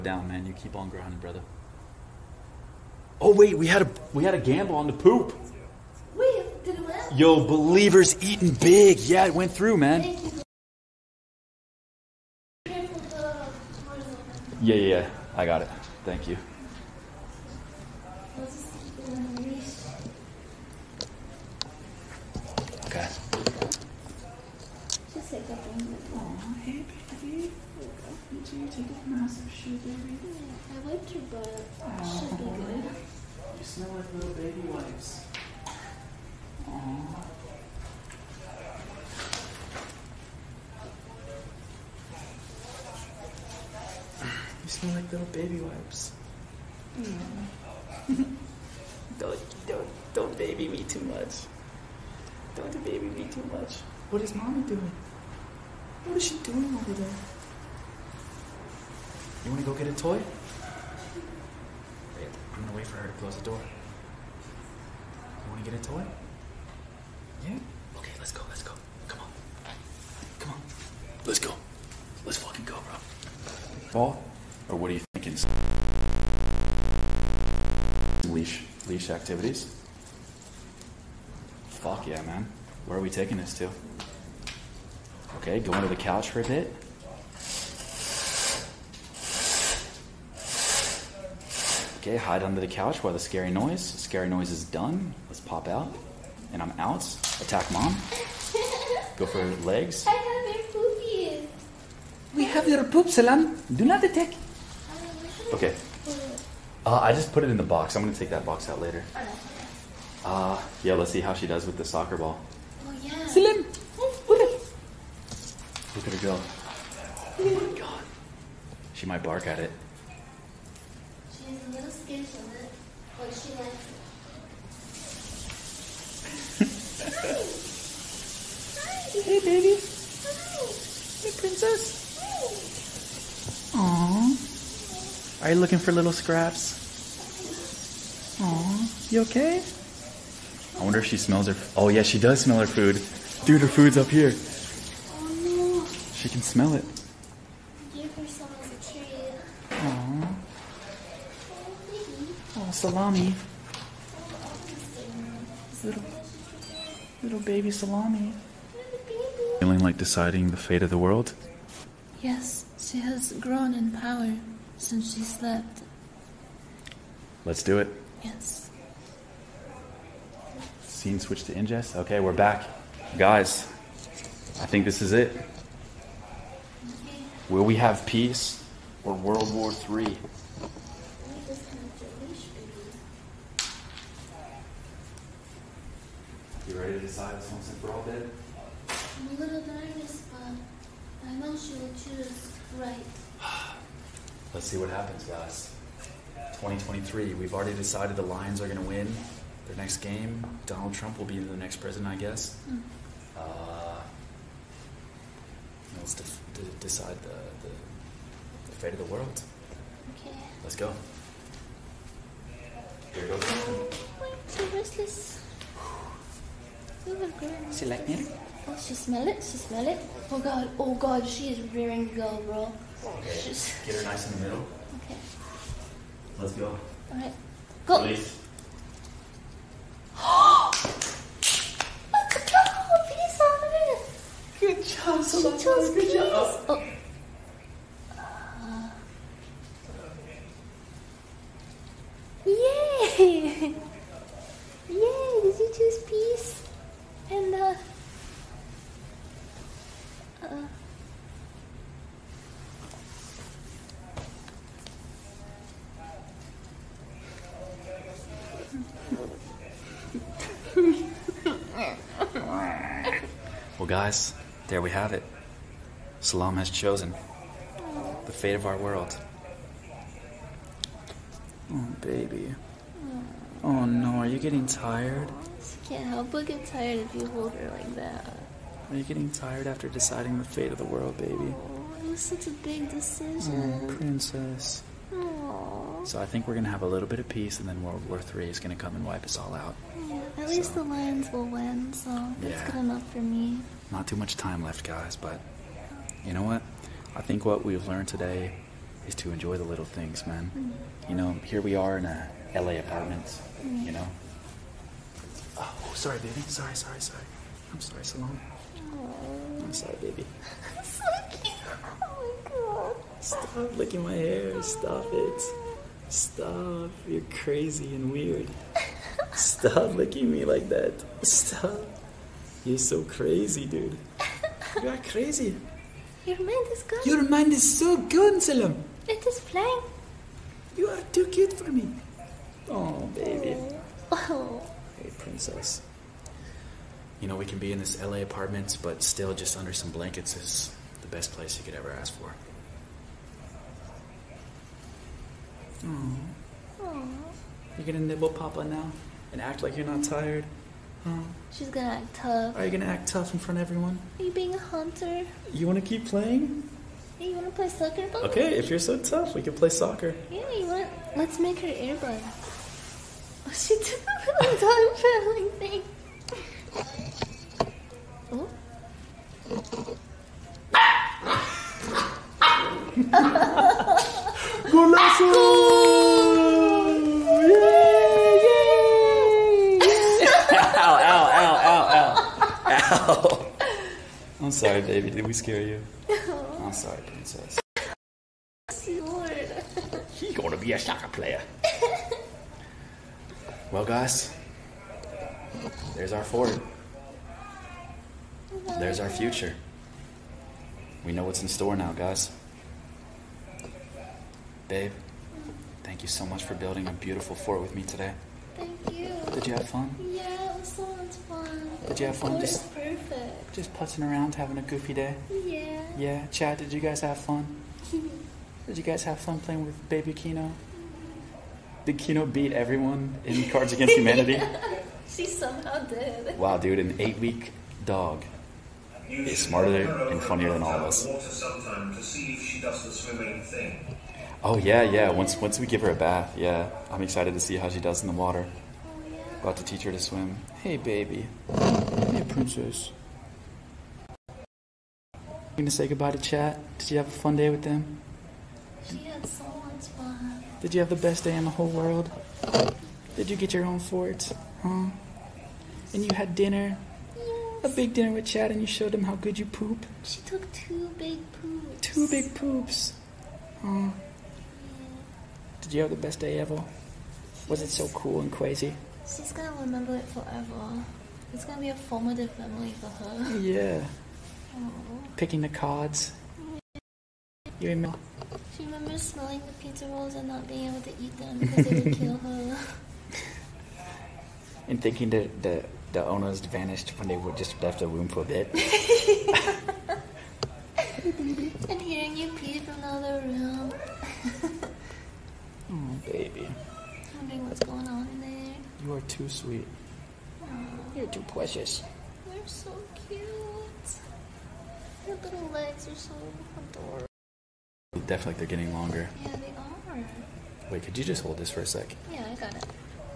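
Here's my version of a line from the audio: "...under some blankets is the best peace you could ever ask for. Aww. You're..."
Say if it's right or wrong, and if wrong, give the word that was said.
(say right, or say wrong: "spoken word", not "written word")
wrong: "place", not "peace".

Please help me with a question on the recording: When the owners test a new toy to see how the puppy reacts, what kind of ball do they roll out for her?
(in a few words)
soccer ball.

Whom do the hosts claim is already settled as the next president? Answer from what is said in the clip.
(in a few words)
Donald Trump.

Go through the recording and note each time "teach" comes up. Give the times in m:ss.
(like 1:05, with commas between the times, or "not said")
7:19.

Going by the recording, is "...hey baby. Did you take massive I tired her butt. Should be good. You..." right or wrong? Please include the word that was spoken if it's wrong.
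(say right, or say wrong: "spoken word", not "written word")
wrong: "wiped", not "tired".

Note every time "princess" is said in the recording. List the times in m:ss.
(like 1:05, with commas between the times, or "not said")
2:11, 4:43, 5:35, 6:27, 7:22.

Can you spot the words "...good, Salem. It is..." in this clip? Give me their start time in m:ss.
5:27.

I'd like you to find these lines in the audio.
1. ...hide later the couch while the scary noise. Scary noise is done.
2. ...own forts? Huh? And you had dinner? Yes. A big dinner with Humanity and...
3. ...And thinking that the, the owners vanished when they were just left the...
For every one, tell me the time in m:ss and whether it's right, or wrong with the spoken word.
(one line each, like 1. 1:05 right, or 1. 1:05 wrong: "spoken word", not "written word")
1. 1:32 wrong: "under", not "later"
2. 7:33 wrong: "Chad", not "Humanity"
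3. 8:04 right.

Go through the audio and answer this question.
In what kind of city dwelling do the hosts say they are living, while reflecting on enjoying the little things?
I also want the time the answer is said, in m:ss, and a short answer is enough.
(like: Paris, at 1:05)
LA apartment, at 5:02.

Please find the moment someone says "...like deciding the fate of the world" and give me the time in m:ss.
2:39.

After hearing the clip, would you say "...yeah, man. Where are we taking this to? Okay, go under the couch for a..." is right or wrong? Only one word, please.
right.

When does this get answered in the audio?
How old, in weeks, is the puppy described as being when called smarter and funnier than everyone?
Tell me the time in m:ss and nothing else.
7:06.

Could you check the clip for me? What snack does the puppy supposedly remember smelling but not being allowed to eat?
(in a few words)
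pizza rolls.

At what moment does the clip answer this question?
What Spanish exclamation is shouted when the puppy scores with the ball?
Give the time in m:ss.
6:14.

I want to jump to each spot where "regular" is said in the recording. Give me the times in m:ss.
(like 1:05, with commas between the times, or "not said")
not said.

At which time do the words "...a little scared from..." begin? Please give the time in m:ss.
2:01.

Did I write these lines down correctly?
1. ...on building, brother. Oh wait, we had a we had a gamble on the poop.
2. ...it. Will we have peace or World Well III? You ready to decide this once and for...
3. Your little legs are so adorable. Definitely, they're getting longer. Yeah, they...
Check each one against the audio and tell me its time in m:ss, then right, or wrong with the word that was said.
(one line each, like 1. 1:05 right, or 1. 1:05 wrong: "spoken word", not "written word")
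1. 0:00 wrong: "grinding", not "building"
2. 2:55 wrong: "War", not "Well"
3. 8:25 right.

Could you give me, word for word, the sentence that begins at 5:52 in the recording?
Are you gonna act tough in front of everyone?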